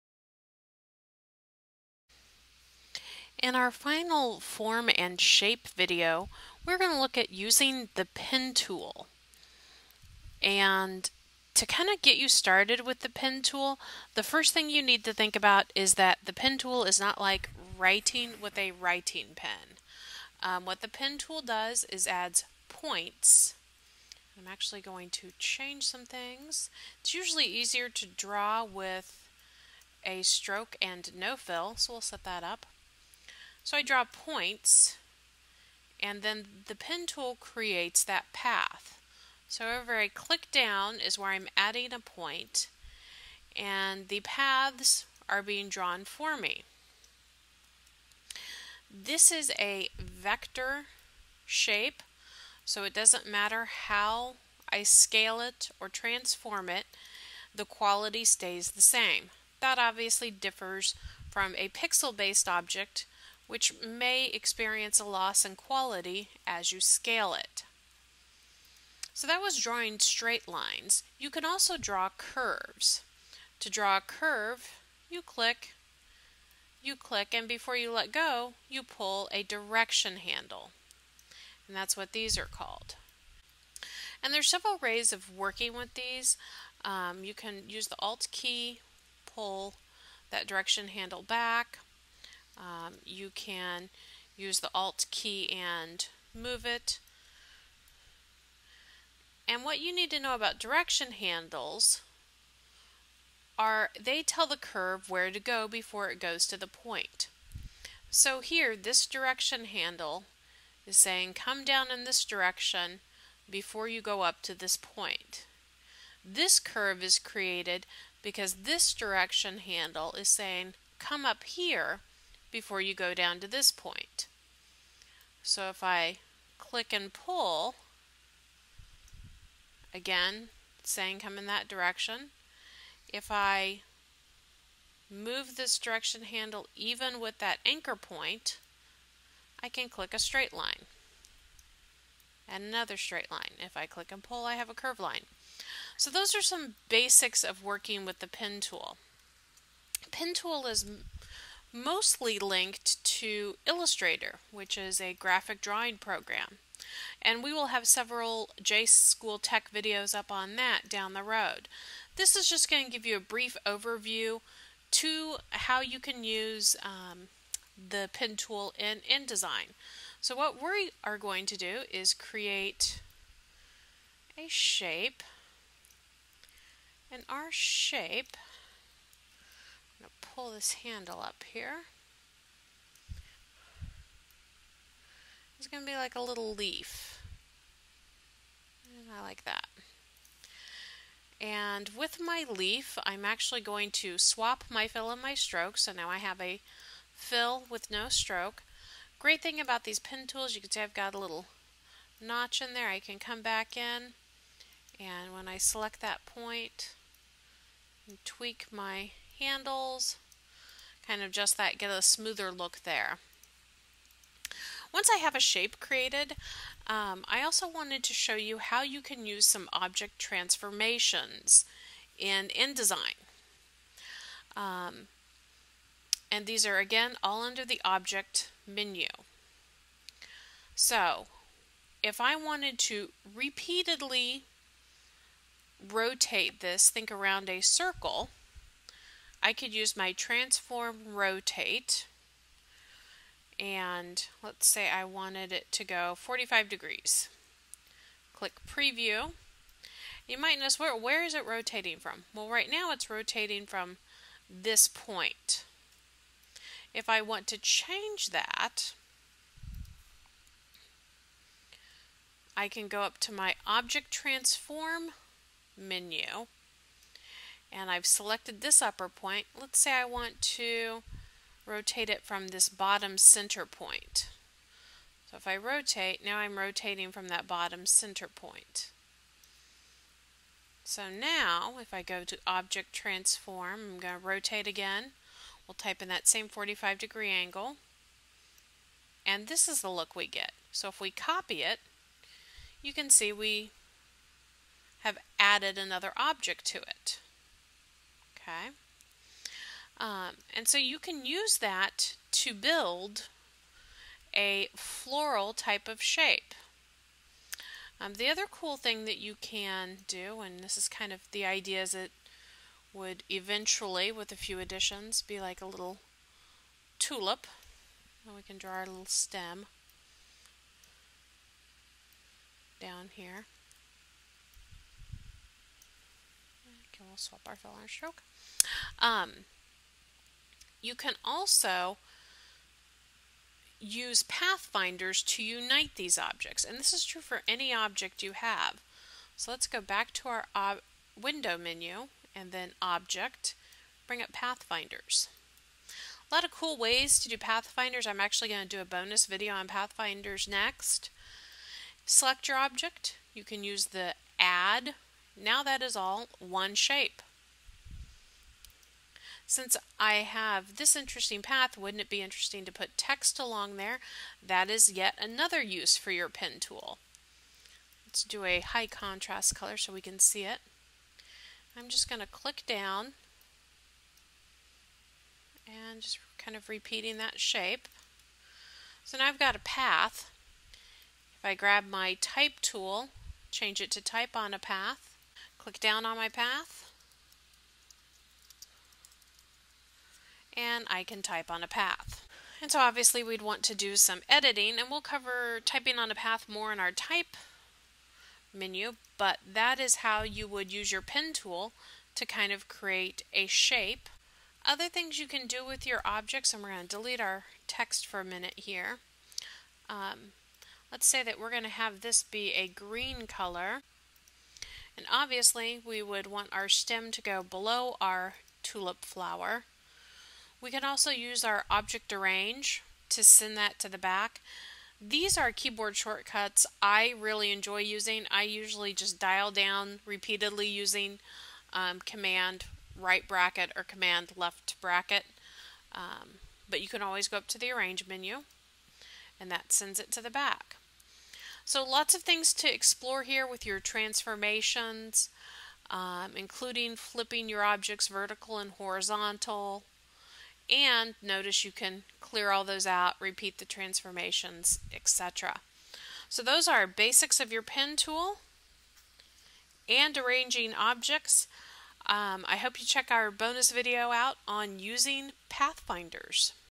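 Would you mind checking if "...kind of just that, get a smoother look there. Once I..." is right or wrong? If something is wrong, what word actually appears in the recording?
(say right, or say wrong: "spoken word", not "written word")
right.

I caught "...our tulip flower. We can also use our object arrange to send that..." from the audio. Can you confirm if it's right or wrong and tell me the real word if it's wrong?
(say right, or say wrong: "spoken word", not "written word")
right.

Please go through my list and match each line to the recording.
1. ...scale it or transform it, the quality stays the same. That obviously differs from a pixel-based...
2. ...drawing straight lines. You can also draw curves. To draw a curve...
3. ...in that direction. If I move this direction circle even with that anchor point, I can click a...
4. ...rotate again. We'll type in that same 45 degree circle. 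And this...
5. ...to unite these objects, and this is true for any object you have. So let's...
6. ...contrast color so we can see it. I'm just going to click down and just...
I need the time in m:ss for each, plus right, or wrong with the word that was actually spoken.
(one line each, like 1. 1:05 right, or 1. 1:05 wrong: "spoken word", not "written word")
1. 0:54 right
2. 1:09 right
3. 2:11 wrong: "handle", not "circle"
4. 4:44 wrong: "angle", not "circle"
5. 5:35 right
6. 6:08 right.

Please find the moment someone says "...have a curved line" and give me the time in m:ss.
2:24.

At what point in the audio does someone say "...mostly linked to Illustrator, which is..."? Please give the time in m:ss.
2:31.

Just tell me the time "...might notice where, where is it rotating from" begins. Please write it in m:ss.
4:10.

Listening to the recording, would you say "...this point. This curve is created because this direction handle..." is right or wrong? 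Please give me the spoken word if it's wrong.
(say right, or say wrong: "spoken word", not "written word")
right.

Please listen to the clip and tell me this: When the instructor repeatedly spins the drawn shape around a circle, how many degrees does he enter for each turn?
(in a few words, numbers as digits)
45.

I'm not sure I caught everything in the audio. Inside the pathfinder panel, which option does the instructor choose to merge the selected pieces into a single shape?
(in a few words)
add.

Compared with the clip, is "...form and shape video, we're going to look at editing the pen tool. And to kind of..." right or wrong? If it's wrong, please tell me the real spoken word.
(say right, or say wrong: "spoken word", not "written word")
wrong: "using", not "editing".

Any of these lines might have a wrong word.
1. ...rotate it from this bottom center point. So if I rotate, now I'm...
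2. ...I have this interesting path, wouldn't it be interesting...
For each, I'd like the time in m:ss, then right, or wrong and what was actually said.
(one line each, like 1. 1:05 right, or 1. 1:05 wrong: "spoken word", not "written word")
1. 4:31 right
2. 5:59 right.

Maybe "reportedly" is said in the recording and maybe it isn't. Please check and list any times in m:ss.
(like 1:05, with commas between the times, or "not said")
not said.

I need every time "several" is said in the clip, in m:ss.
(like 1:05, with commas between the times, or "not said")
1:24, 2:37.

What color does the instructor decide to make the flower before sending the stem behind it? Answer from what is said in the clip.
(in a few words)
green.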